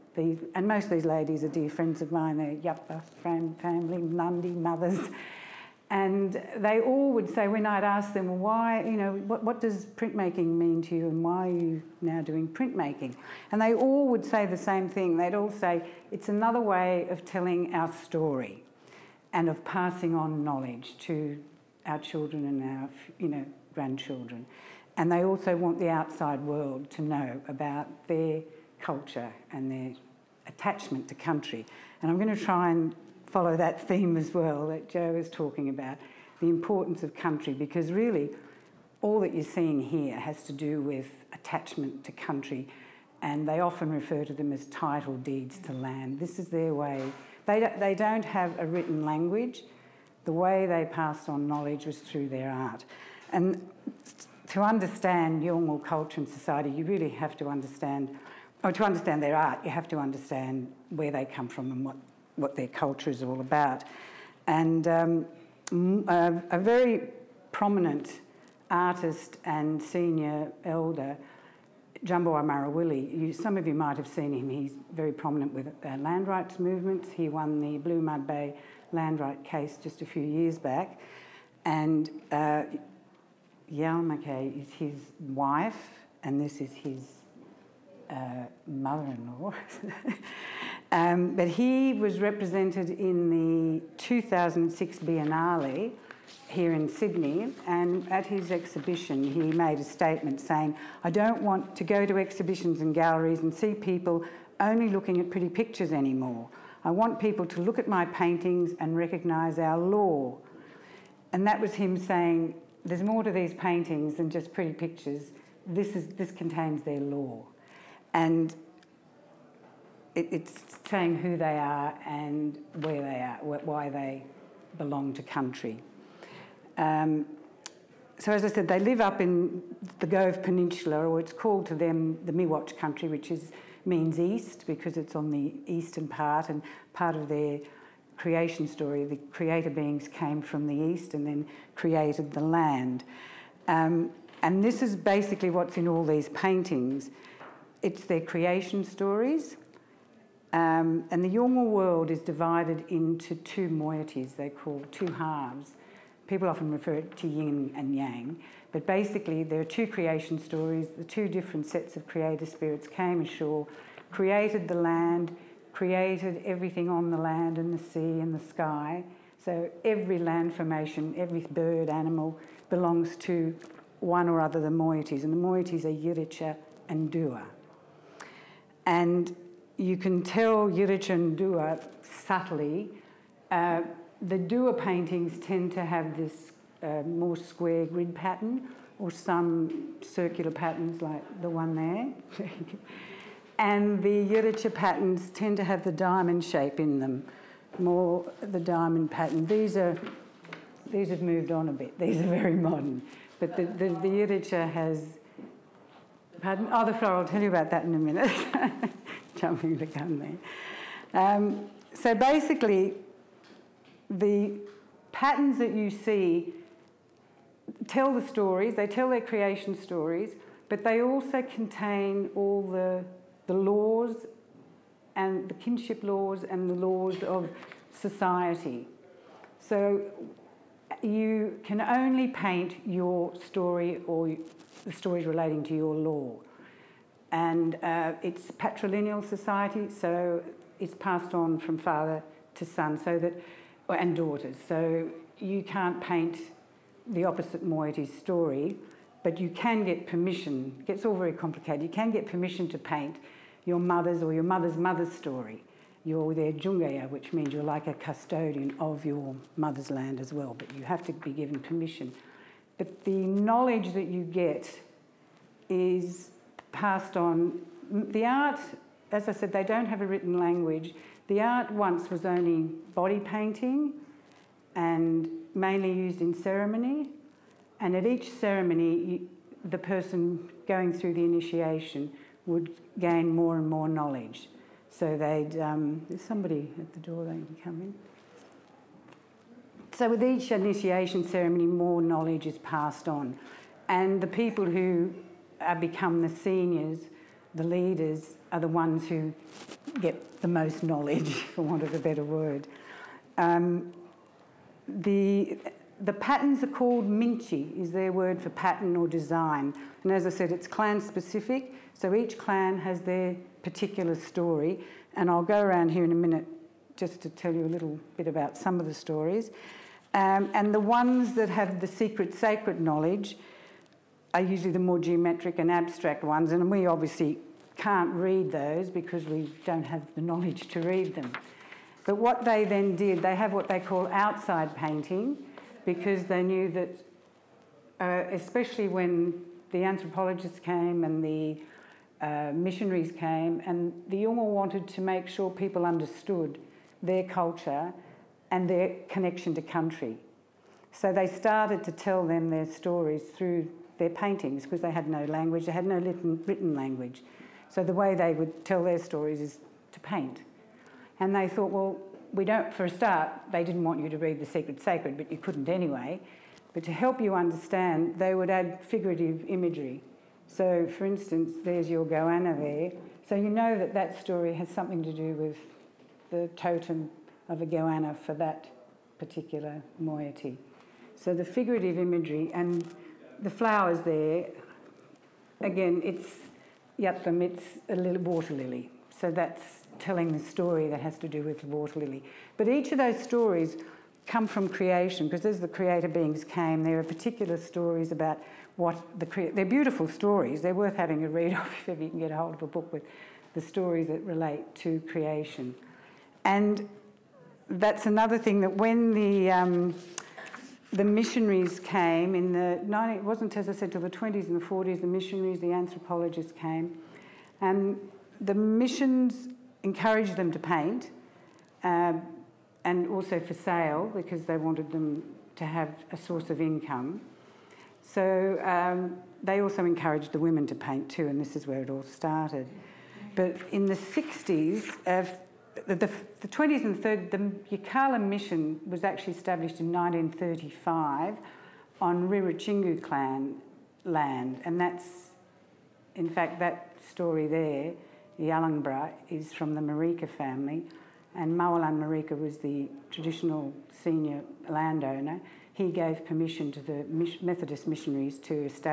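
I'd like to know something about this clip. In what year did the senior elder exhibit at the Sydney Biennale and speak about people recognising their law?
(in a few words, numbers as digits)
2006.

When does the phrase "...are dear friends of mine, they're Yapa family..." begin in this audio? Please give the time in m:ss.
0:01.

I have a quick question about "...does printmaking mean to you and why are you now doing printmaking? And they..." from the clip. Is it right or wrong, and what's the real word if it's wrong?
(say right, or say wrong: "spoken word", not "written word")
right.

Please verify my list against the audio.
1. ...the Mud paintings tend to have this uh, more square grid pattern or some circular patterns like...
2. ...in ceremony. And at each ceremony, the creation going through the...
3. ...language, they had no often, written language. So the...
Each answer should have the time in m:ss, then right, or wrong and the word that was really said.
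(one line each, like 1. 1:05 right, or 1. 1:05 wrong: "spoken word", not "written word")
1. 3:04 wrong: "Dhuwa", not "Mud"
2. 4:36 wrong: "person", not "creation"
3. 5:55 wrong: "written", not "often".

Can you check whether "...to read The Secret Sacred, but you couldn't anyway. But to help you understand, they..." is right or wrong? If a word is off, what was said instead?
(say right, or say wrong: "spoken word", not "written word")
right.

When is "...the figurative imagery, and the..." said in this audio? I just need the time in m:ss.
6:21.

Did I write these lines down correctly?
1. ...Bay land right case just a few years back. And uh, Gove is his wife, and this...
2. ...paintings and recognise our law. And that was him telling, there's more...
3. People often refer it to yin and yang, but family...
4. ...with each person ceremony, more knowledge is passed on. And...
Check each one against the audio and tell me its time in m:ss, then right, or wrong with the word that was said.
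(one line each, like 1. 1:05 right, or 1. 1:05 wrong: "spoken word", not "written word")
1. 1:18 wrong: "McKay", not "Gove"
2. 1:48 wrong: "saying", not "telling"
3. 2:36 wrong: "basically", not "family"
4. 4:50 wrong: "initiation", not "person".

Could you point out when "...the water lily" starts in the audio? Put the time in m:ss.
6:31.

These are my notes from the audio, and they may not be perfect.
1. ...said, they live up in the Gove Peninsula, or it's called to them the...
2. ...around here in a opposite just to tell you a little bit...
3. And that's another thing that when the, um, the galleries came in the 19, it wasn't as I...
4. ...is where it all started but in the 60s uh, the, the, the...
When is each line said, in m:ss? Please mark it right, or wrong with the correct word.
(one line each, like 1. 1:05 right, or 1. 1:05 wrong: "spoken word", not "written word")
1. 2:08 right
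2. 5:15 wrong: "minute", not "opposite"
3. 6:46 wrong: "missionaries", not "galleries"
4. 7:11 right.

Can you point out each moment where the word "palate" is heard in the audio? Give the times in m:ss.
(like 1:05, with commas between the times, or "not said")
not said.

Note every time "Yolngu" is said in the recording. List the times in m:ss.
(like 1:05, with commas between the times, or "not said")
0:55, 2:31, 5:44.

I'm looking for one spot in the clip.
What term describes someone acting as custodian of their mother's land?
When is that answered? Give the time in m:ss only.
4:16.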